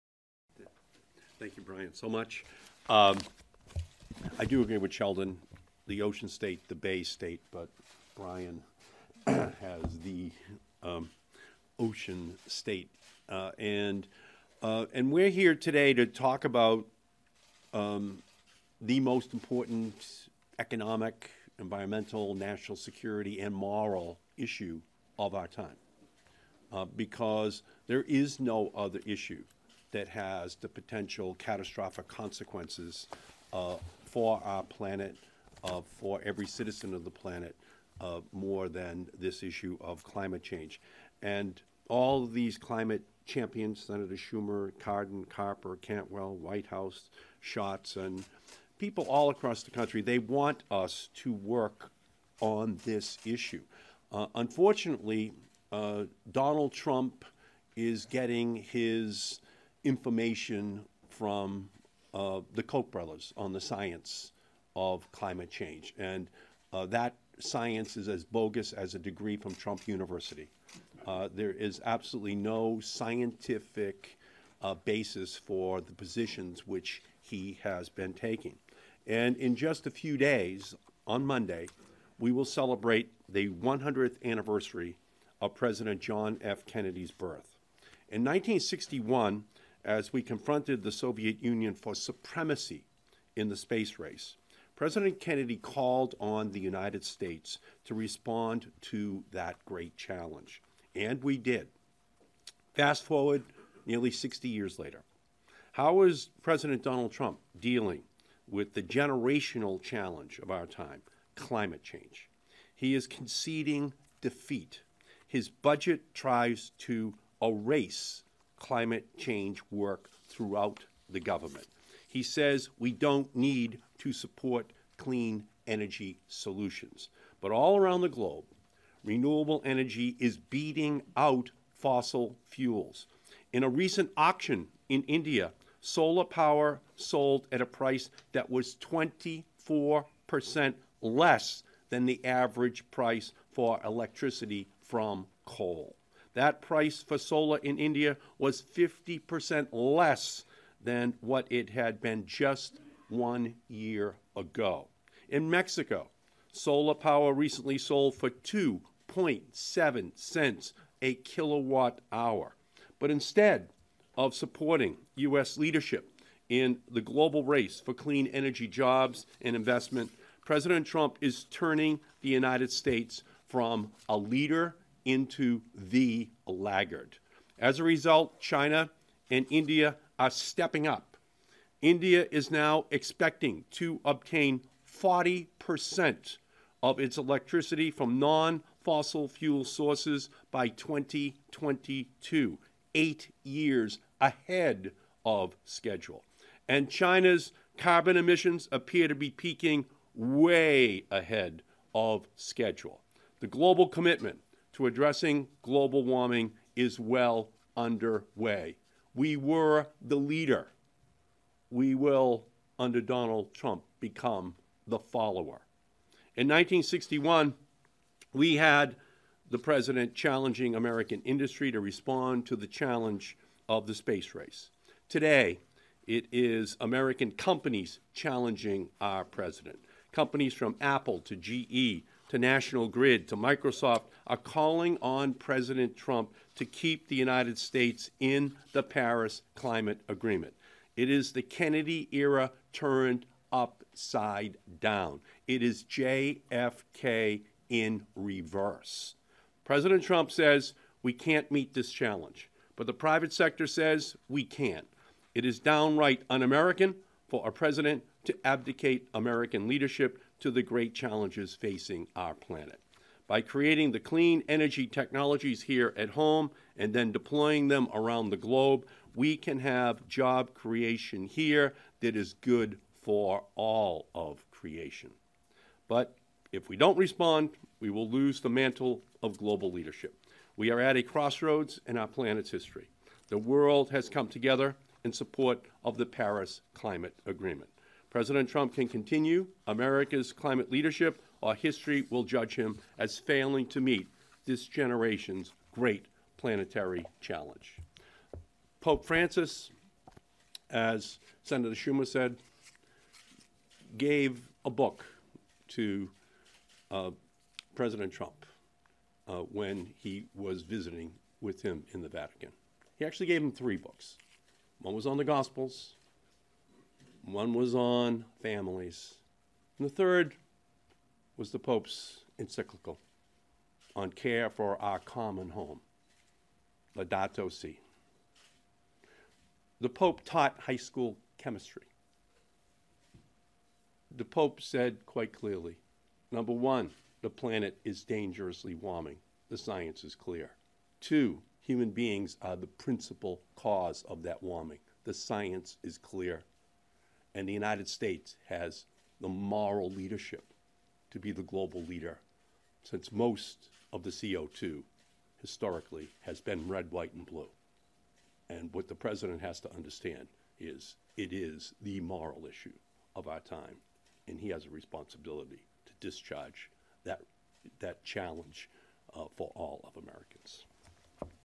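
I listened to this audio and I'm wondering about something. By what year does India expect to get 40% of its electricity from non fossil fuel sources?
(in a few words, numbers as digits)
2022.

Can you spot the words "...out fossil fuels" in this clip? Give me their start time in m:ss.
2:11.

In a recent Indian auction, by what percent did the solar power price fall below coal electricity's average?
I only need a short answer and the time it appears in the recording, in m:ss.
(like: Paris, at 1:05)
24%, at 2:18.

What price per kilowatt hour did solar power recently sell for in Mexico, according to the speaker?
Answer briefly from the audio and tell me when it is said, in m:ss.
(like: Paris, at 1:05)
2.7 cents, at 2:38.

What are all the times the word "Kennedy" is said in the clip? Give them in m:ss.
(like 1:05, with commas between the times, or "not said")
1:26, 1:35, 4:01.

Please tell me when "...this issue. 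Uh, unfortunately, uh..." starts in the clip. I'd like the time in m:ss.
0:52.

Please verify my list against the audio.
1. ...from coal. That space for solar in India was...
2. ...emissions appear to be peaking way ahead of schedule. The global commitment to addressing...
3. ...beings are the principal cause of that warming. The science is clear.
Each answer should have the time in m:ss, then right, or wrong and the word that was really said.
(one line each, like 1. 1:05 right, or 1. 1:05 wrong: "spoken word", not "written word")
1. 2:24 wrong: "price", not "space"
2. 3:18 right
3. 5:41 right.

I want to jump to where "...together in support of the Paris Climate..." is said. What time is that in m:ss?
4:44.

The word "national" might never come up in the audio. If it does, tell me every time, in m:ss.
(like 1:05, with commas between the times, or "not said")
0:22, 3:52.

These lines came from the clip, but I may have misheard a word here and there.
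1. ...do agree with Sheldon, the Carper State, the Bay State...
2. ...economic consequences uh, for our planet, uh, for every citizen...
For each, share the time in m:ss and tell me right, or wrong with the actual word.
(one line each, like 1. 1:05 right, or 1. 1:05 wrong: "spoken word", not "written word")
1. 0:04 wrong: "Ocean", not "Carper"
2. 0:31 wrong: "catastrophic", not "economic".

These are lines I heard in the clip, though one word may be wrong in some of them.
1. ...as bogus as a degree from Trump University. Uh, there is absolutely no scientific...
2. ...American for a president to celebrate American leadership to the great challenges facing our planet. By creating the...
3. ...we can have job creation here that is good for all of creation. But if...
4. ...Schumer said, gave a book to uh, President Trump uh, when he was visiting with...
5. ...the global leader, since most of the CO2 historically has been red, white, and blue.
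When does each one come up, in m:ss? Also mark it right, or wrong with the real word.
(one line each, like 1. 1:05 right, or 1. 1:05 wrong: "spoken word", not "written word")
1. 1:08 right
2. 4:16 wrong: "abdicate", not "celebrate"
3. 4:29 right
4. 5:01 right
5. 5:51 right.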